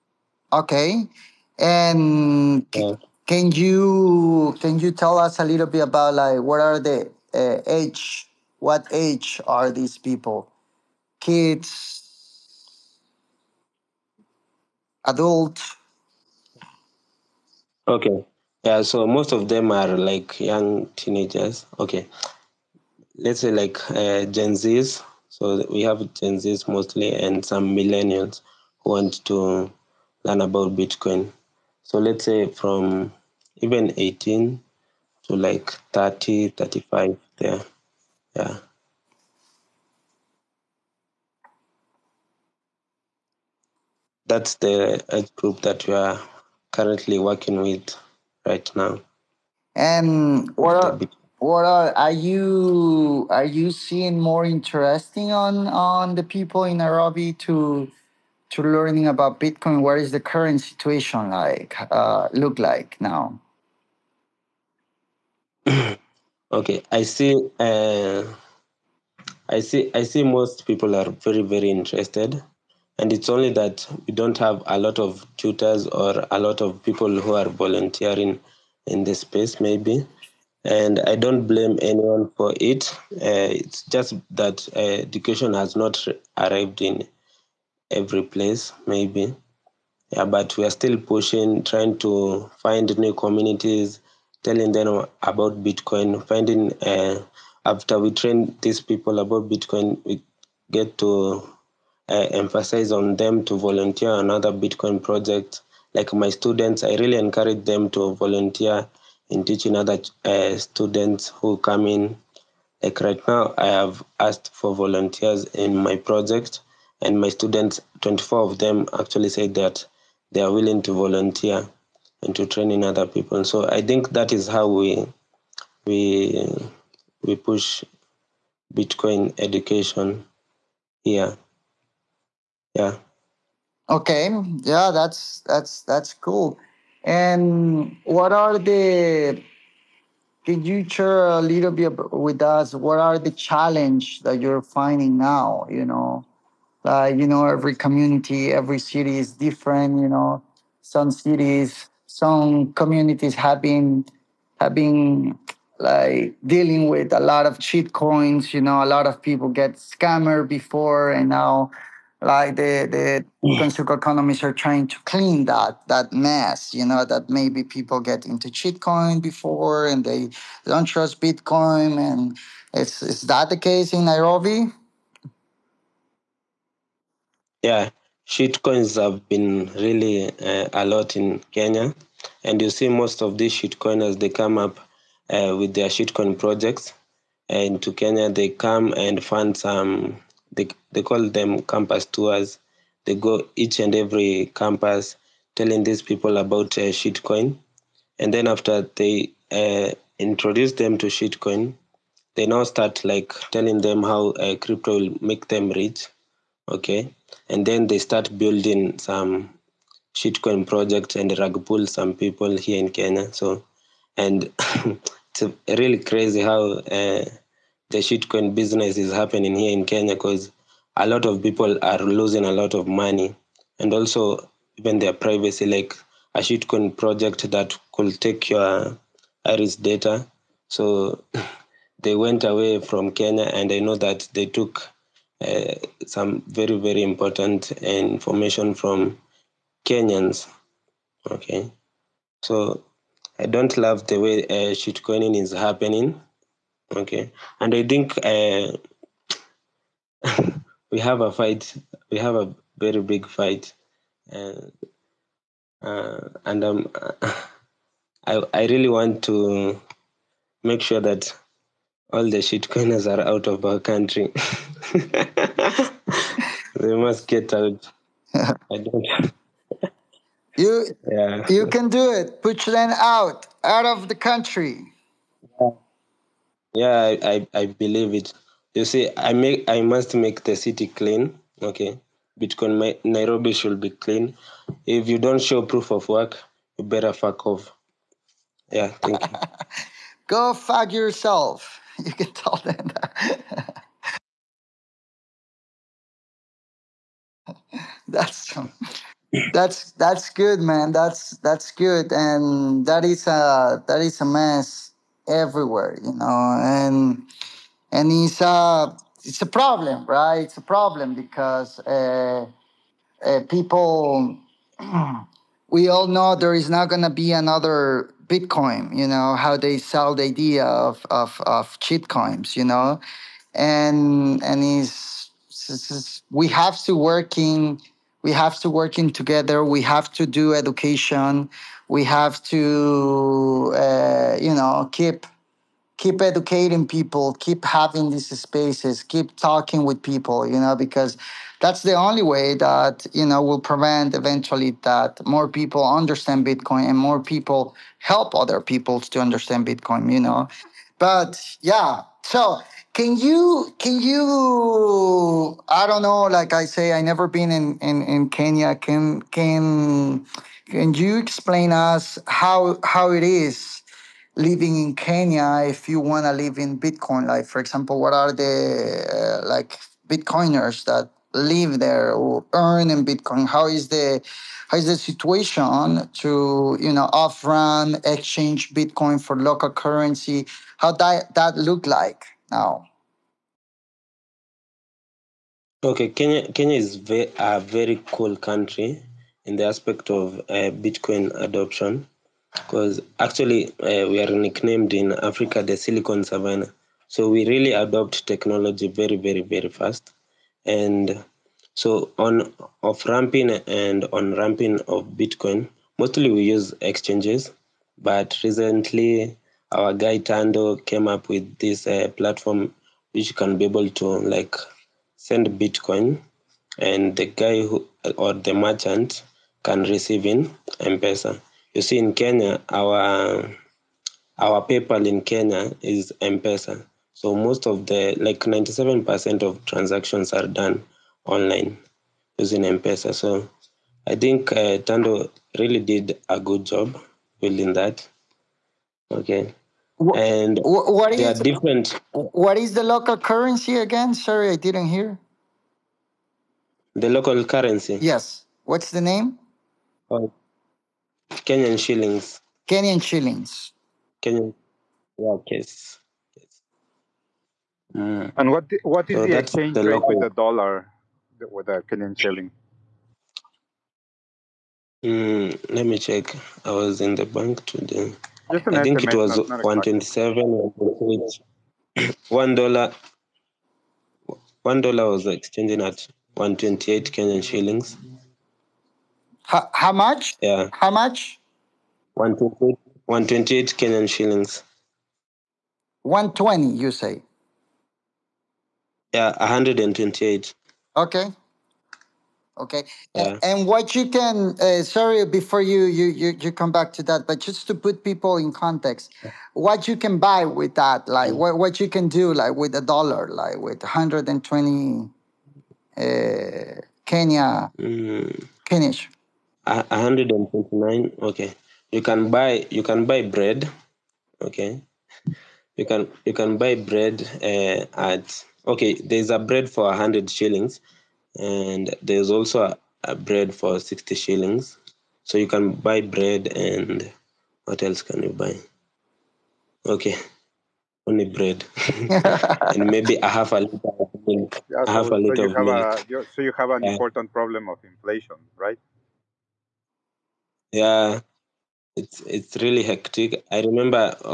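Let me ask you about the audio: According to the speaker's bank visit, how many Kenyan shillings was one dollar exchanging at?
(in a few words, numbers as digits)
128.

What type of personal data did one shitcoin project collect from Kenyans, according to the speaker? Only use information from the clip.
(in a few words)
iris data.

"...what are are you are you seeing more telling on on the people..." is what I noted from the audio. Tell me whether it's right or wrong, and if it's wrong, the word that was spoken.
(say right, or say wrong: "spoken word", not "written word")
wrong: "interesting", not "telling".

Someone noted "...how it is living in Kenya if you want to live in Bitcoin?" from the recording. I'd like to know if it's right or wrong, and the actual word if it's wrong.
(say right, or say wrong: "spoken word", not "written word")
right.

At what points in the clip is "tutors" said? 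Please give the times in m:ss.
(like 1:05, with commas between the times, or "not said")
1:15.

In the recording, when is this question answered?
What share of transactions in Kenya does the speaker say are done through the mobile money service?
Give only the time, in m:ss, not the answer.
7:08.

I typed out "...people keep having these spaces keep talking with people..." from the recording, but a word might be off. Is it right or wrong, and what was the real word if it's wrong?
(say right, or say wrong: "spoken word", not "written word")
right.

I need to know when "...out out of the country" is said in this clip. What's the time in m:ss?
4:32.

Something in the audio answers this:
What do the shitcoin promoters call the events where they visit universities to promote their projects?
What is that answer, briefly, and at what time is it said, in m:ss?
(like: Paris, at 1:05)
campus tours, at 3:11.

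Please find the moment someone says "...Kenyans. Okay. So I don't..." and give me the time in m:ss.
3:59.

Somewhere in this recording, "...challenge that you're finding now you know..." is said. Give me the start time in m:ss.
2:23.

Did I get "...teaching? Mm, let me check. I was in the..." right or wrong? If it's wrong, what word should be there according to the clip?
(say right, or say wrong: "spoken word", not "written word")
wrong: "shilling", not "teaching".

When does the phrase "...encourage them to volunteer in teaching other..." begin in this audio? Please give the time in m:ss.
1:47.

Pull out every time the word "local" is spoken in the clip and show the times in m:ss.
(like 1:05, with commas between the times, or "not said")
6:19, 7:22, 7:27.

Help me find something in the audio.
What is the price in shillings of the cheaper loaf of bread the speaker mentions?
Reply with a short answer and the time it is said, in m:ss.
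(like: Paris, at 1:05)
60 shillings, at 8:43.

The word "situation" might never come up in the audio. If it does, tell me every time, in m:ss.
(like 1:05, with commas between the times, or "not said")
1:00, 6:14.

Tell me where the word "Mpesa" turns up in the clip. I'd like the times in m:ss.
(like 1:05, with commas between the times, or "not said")
7:00, 7:06.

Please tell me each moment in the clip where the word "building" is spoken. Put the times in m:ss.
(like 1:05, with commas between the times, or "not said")
3:28, 7:17.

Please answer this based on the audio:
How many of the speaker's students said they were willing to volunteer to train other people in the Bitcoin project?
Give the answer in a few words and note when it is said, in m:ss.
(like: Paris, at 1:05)
24, at 1:58.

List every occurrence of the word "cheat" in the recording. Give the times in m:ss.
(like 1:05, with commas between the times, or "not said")
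2:37, 2:48, 2:58, 3:03, 5:21.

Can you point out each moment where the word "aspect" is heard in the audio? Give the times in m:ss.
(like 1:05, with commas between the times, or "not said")
6:29.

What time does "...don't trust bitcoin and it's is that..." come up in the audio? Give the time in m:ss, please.
2:50.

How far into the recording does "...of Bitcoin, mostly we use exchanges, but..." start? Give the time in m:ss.
6:44.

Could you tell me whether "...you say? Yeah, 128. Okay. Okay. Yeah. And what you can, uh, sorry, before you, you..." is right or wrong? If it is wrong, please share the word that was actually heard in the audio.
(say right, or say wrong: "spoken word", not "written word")
right.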